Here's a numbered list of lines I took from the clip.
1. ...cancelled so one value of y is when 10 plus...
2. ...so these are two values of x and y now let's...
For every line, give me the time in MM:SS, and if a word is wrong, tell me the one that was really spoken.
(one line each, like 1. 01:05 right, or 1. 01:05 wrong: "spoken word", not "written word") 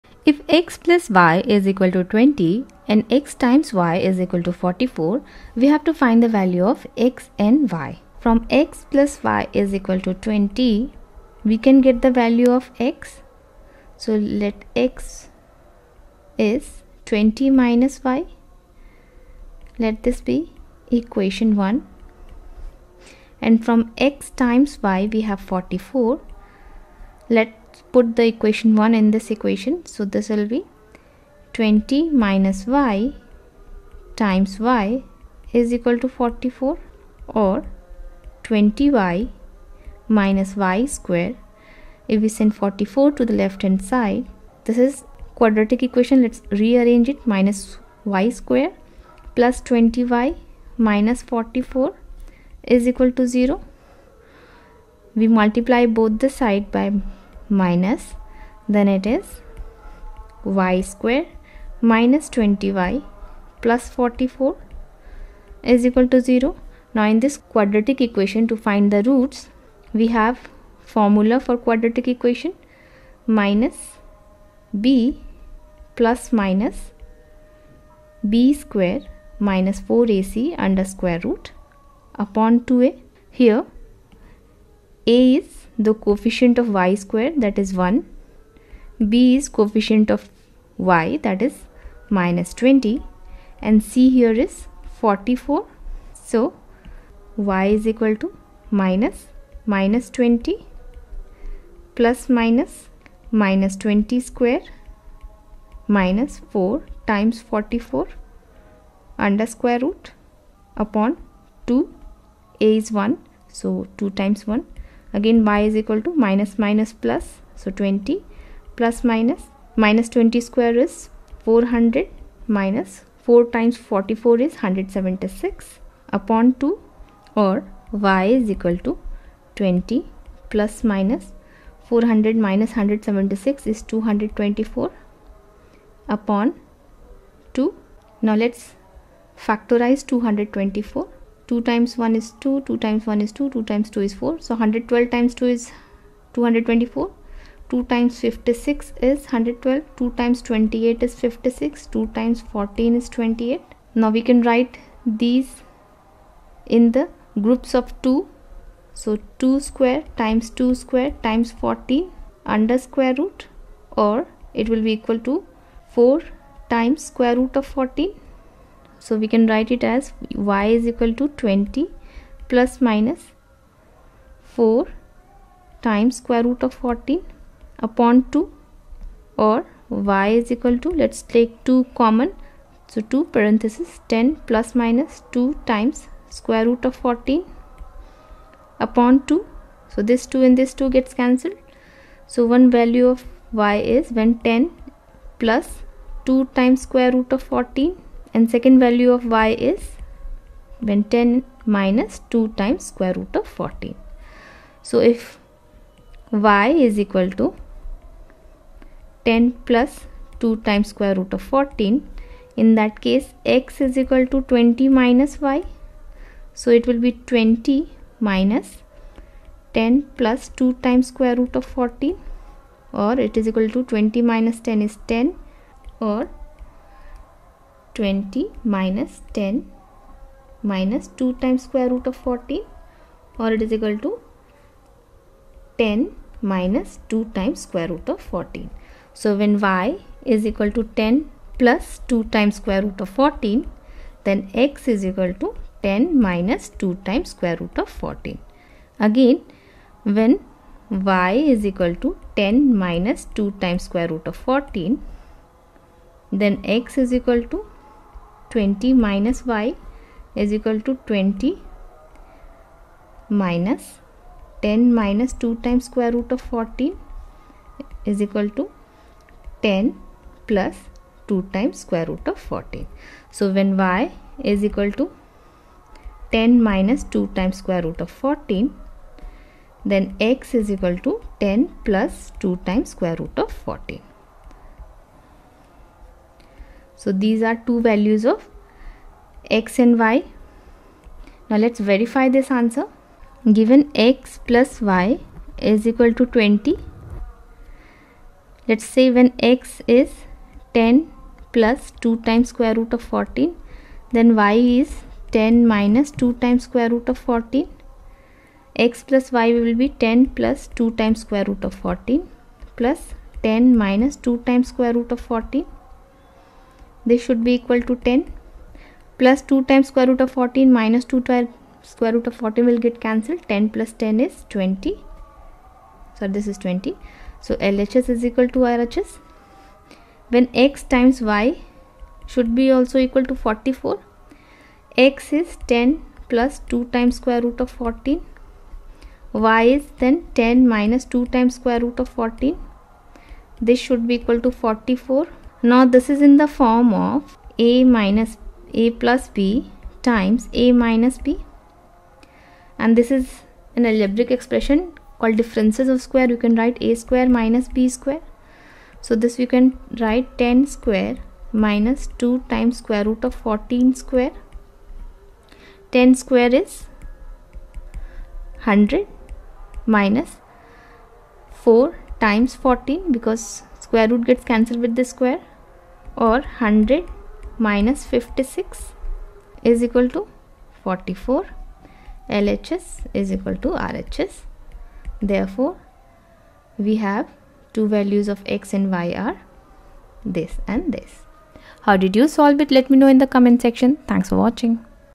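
1. 03:11 right
2. 04:47 right.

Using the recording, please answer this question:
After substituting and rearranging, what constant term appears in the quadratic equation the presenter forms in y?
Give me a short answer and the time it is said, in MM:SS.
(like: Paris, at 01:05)
44, at 01:03.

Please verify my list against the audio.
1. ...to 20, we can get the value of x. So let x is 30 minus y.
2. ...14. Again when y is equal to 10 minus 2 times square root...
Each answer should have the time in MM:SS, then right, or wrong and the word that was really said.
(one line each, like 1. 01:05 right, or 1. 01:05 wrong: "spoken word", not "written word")
1. 00:10 wrong: "20", not "30"
2. 04:07 right.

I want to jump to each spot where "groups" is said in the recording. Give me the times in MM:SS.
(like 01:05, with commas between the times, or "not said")
02:37.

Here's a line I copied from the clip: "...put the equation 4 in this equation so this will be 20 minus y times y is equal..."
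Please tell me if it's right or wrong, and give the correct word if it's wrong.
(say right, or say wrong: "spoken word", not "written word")
wrong: "1", not "4".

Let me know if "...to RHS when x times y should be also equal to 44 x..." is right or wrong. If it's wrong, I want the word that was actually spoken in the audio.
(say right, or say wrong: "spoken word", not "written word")
right.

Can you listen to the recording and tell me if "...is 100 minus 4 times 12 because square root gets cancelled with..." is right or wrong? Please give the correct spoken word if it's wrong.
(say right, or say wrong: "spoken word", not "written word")
wrong: "14", not "12".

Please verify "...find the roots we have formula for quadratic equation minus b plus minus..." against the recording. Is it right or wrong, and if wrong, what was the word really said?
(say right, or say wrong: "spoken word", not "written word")
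right.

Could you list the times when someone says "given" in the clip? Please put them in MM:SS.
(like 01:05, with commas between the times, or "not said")
04:53.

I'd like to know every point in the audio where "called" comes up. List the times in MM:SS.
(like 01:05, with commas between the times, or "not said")
05:55.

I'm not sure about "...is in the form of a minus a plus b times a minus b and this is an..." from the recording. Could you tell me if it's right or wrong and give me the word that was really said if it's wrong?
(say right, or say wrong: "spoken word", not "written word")
right.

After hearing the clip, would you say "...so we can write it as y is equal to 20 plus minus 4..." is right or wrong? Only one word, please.
right.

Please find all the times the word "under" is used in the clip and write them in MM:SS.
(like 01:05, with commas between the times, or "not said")
01:20, 01:49, 02:42.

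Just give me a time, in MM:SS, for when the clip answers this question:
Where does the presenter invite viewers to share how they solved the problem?
06:33.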